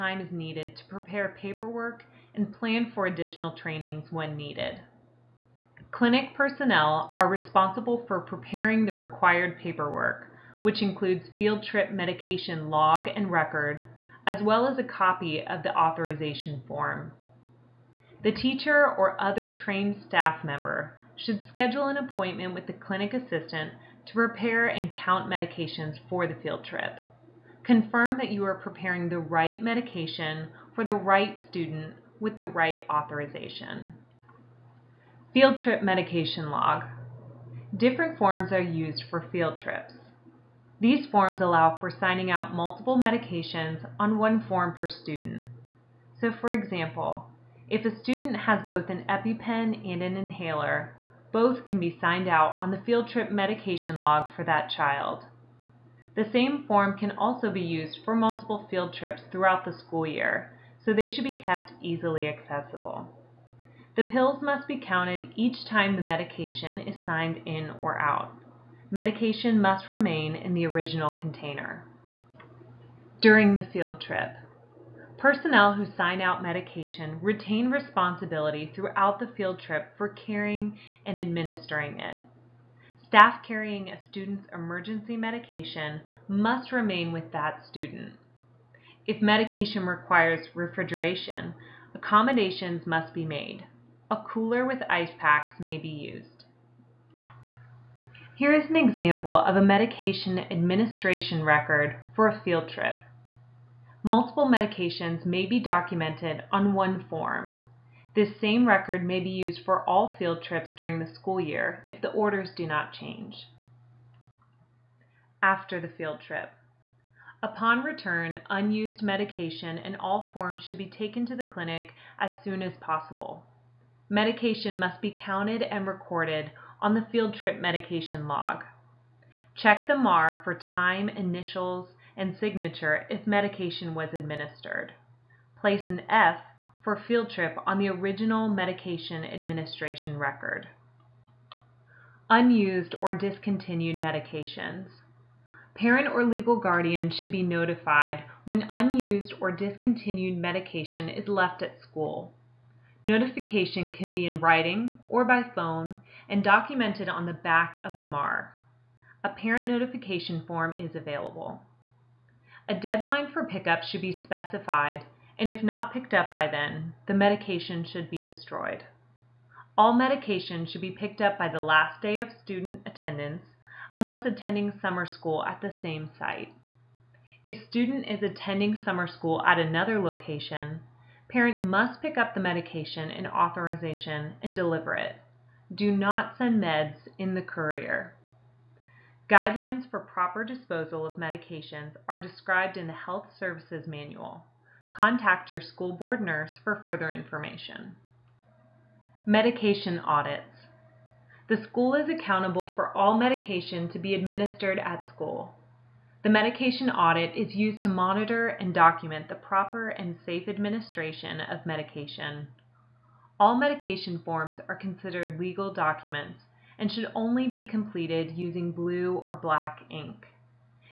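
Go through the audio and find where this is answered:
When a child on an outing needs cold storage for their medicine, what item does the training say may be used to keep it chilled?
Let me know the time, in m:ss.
1:34.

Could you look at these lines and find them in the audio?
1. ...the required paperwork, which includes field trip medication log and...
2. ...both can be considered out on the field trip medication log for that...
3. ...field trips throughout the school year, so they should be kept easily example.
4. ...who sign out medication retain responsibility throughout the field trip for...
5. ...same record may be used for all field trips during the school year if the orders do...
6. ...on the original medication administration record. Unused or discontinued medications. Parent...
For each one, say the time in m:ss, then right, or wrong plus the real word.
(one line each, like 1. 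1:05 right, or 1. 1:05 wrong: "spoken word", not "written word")
1. 0:08 right
2. 0:51 wrong: "signed", not "considered"
3. 0:58 wrong: "accessible", not "example"
4. 1:15 right
5. 1:48 right
6. 2:17 right.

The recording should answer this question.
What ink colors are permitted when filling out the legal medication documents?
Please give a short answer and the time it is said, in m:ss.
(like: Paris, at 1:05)
Blue or black, at 3:38.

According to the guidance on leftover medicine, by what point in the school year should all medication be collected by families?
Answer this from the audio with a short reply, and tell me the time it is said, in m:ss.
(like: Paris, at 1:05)
Last day of student attendance, at 2:51.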